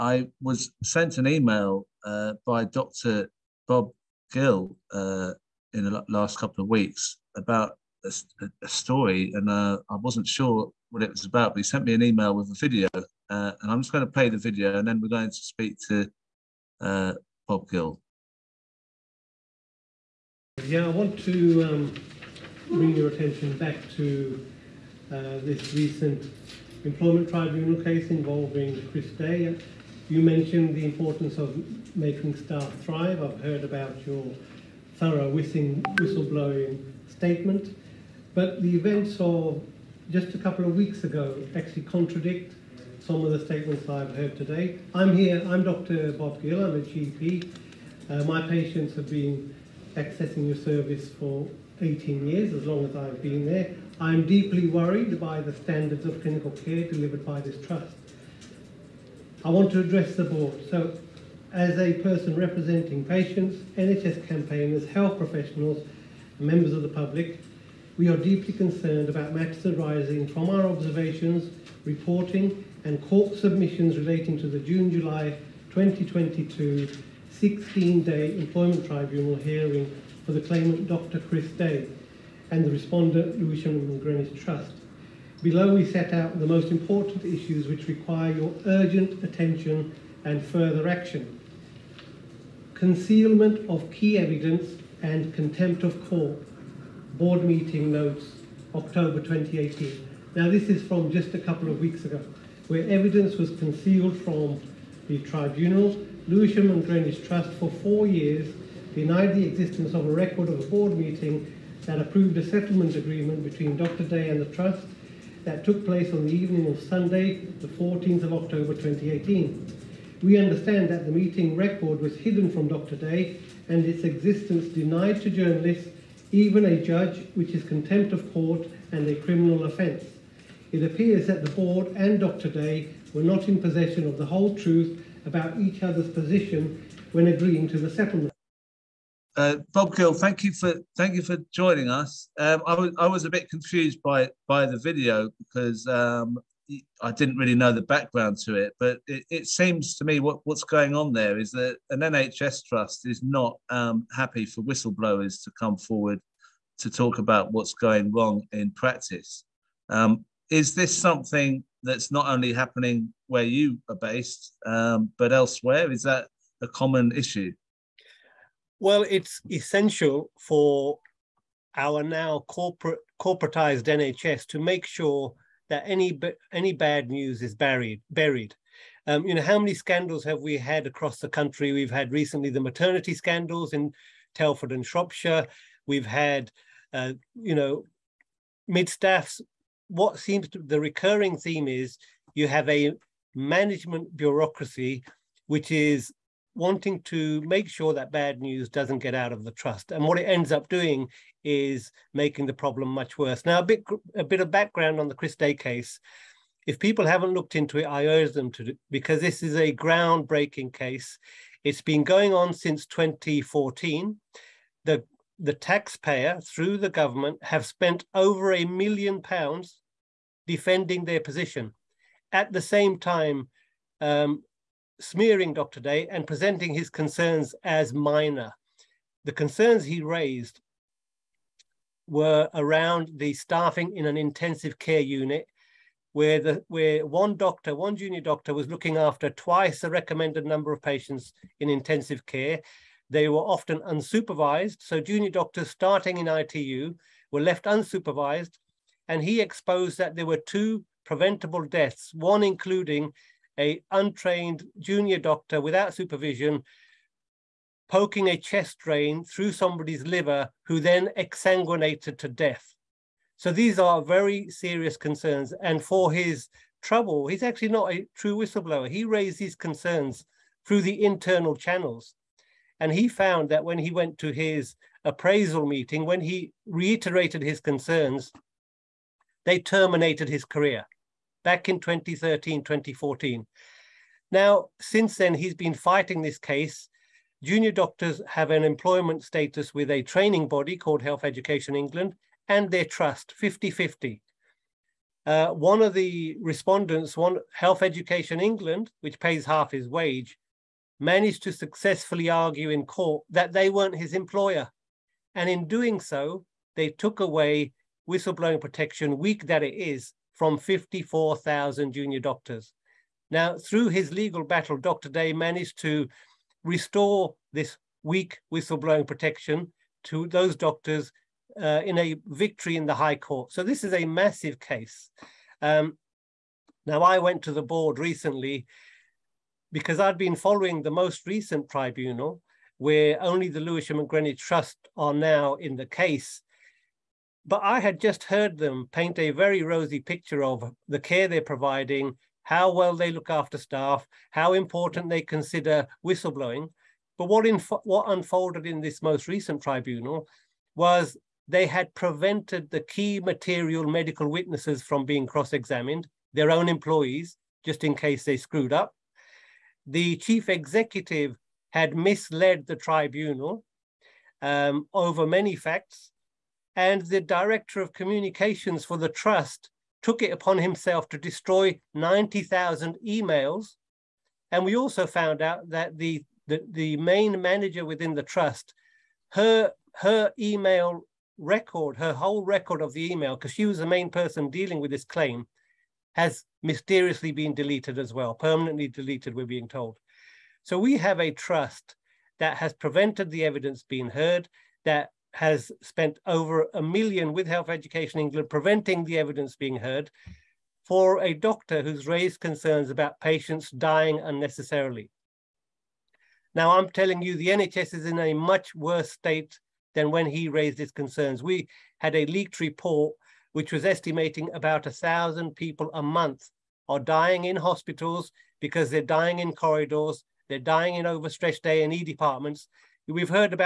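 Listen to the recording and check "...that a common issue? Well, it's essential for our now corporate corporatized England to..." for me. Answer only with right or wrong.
wrong.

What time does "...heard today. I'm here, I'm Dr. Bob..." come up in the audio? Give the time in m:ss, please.
0:44.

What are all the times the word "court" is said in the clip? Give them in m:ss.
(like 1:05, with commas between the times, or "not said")
1:13, 1:36, 2:08, 5:02, 5:23.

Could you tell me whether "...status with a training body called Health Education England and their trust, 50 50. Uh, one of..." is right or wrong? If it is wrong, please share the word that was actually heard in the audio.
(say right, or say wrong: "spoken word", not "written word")
right.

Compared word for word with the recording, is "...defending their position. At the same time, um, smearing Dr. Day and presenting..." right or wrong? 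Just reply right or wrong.
right.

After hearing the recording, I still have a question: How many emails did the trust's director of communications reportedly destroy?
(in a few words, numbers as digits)
90,000.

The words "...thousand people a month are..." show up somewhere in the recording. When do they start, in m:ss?
6:55.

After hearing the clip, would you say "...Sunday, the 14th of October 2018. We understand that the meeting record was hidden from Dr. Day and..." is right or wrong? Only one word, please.
right.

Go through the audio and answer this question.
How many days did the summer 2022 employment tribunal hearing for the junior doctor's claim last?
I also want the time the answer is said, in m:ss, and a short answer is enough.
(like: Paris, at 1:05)
16, at 1:17.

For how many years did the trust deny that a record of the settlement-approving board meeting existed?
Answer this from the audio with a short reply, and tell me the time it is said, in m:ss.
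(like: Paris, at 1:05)
4 years, at 1:47.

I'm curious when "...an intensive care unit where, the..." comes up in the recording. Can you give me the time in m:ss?
3:54.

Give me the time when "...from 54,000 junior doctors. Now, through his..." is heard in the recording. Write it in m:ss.
5:10.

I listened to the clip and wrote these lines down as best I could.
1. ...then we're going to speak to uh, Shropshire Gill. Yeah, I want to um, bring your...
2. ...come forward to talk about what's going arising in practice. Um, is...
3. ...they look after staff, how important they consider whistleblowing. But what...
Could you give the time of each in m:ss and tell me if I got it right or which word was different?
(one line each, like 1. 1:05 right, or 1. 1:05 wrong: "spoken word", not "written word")
1. 0:14 wrong: "Bob", not "Shropshire"
2. 2:35 wrong: "wrong", not "arising"
3. 5:42 right.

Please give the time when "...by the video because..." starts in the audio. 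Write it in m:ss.
2:24.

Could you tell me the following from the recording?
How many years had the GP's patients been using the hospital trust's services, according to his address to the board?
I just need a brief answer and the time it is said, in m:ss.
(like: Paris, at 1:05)
18 years, at 0:51.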